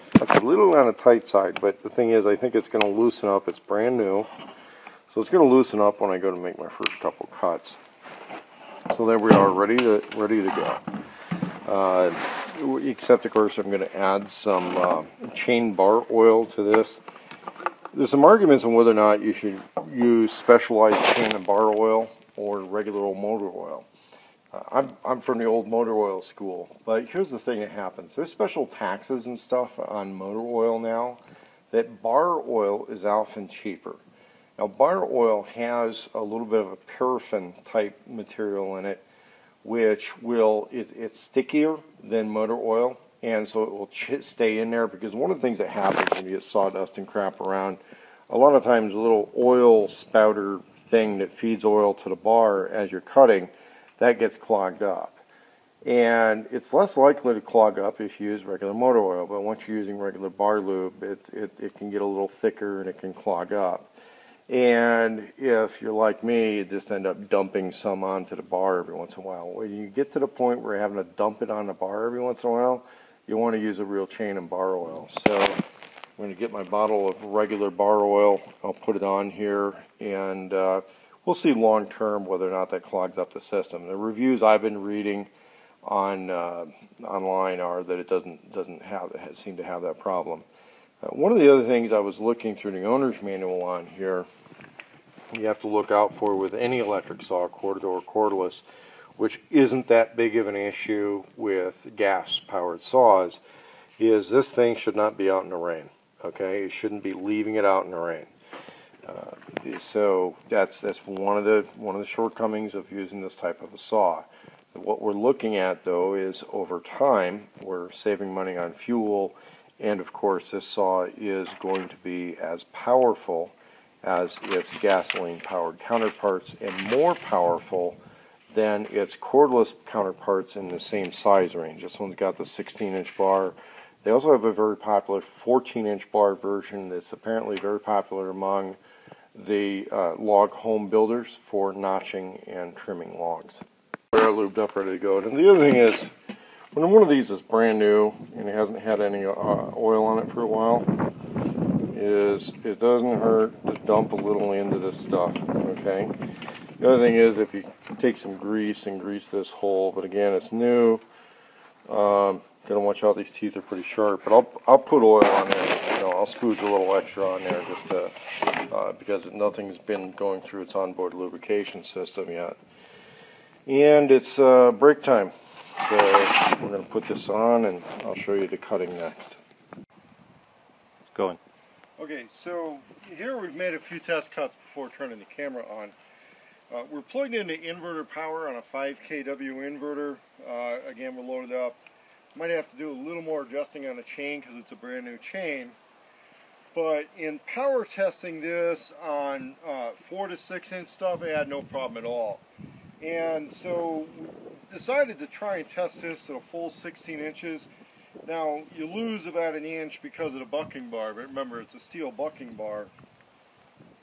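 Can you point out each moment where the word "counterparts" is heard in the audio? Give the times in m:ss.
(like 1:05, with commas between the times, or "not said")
2:05, 2:09.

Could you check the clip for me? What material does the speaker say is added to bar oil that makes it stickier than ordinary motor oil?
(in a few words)
paraffin.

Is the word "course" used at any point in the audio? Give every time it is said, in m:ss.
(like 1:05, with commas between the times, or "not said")
0:13, 2:00.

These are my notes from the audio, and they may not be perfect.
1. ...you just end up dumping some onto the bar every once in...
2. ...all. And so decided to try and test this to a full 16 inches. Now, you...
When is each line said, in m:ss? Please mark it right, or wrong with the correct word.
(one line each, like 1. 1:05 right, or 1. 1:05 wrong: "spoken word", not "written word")
1. 1:06 right
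2. 3:22 right.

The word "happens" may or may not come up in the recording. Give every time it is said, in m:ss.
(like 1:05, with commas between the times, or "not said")
0:27, 0:45.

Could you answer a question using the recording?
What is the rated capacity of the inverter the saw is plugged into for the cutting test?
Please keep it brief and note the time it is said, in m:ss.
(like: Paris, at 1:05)
5 kW, at 3:08.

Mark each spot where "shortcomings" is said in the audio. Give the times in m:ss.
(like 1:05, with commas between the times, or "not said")
1:52.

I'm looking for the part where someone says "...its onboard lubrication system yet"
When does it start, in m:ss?
2:50.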